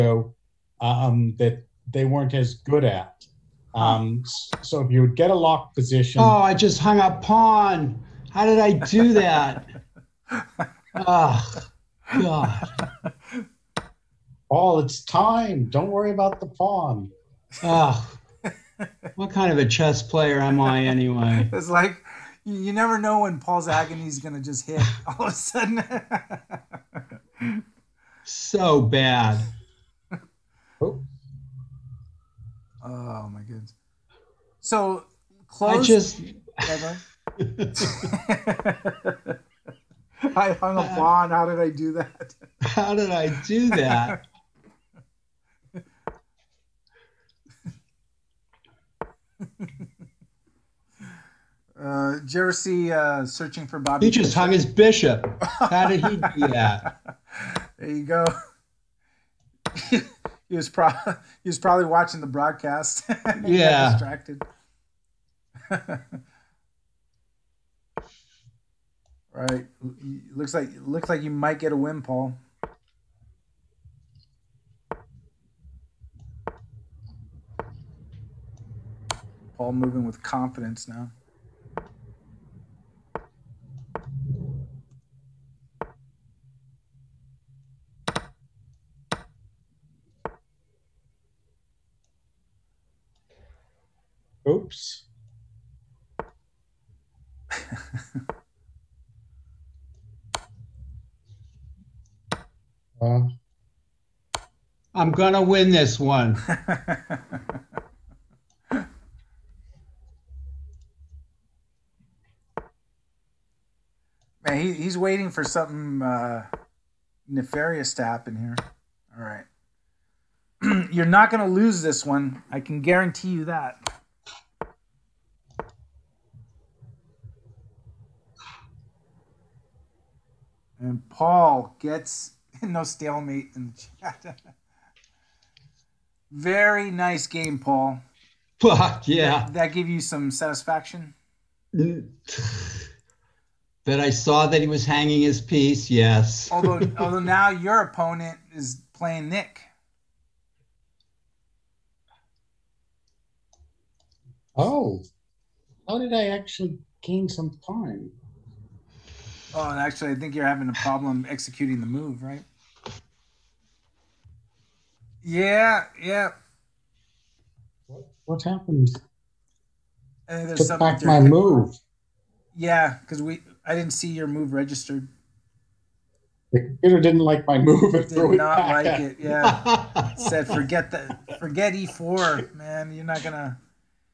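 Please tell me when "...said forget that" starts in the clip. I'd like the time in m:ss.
3:00.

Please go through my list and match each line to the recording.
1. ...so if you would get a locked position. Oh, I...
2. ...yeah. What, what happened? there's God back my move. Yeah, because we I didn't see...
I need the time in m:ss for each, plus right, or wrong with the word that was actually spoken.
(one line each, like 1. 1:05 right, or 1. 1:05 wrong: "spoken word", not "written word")
1. 0:04 right
2. 2:45 wrong: "Took", not "God".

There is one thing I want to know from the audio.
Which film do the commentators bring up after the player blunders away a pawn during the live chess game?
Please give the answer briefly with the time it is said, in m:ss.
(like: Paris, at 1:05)
Searching for Bobby, at 0:53.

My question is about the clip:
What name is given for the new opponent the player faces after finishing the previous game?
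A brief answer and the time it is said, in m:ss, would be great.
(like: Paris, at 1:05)
Nick, at 2:29.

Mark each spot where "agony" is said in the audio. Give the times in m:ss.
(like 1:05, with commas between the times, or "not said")
0:23.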